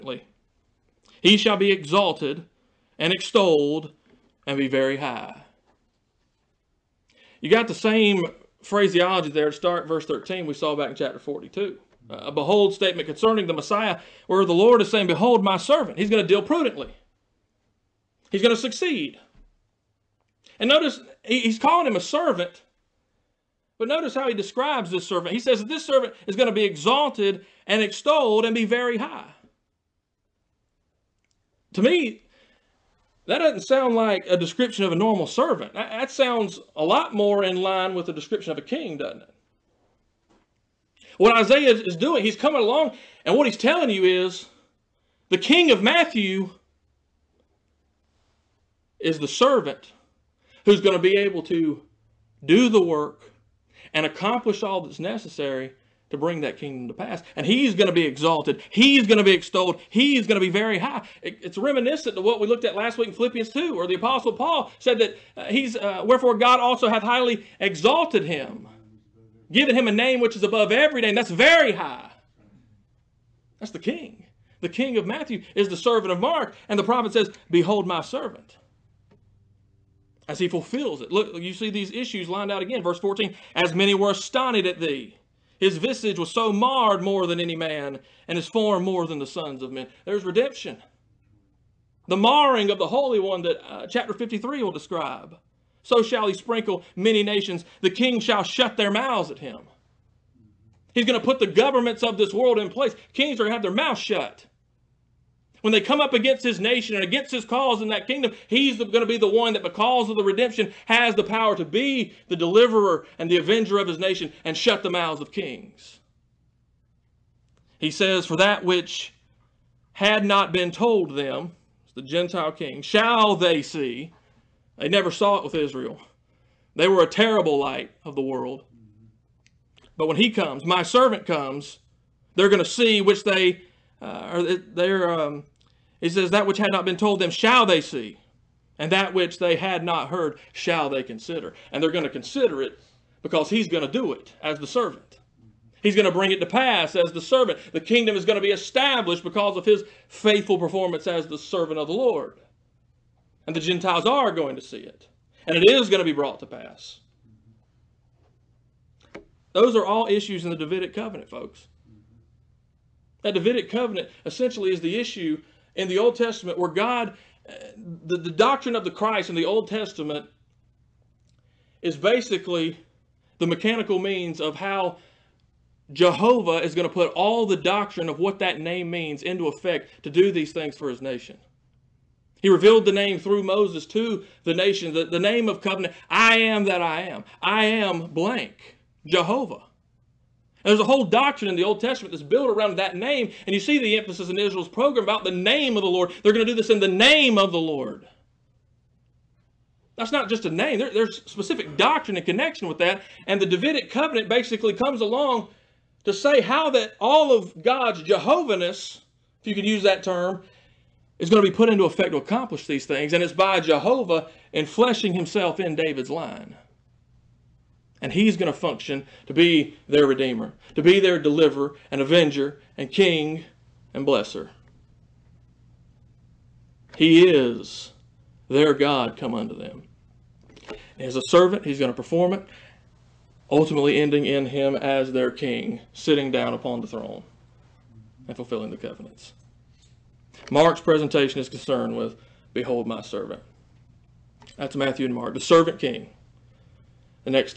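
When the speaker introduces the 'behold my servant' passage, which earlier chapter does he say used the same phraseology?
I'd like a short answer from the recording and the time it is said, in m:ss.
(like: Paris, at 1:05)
Chapter 42, at 0:10.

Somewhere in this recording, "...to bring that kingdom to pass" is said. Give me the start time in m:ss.
0:56.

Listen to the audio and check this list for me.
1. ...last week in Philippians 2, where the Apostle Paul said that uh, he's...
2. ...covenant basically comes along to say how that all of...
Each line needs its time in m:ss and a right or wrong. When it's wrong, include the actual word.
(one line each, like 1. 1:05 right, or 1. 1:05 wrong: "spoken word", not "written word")
1. 1:02 right
2. 3:23 right.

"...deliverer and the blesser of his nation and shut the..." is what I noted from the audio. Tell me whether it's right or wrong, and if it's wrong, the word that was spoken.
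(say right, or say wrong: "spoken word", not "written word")
wrong: "avenger", not "blesser".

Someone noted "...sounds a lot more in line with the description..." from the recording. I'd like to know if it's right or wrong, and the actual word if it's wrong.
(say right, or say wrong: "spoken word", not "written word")
right.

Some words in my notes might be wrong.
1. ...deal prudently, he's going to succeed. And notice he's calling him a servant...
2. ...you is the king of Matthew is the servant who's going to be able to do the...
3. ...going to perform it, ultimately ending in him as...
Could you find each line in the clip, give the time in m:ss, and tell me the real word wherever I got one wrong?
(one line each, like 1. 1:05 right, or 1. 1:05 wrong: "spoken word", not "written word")
1. 0:16 right
2. 0:43 right
3. 3:51 right.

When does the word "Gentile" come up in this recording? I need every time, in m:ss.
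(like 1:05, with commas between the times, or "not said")
2:02, 2:33.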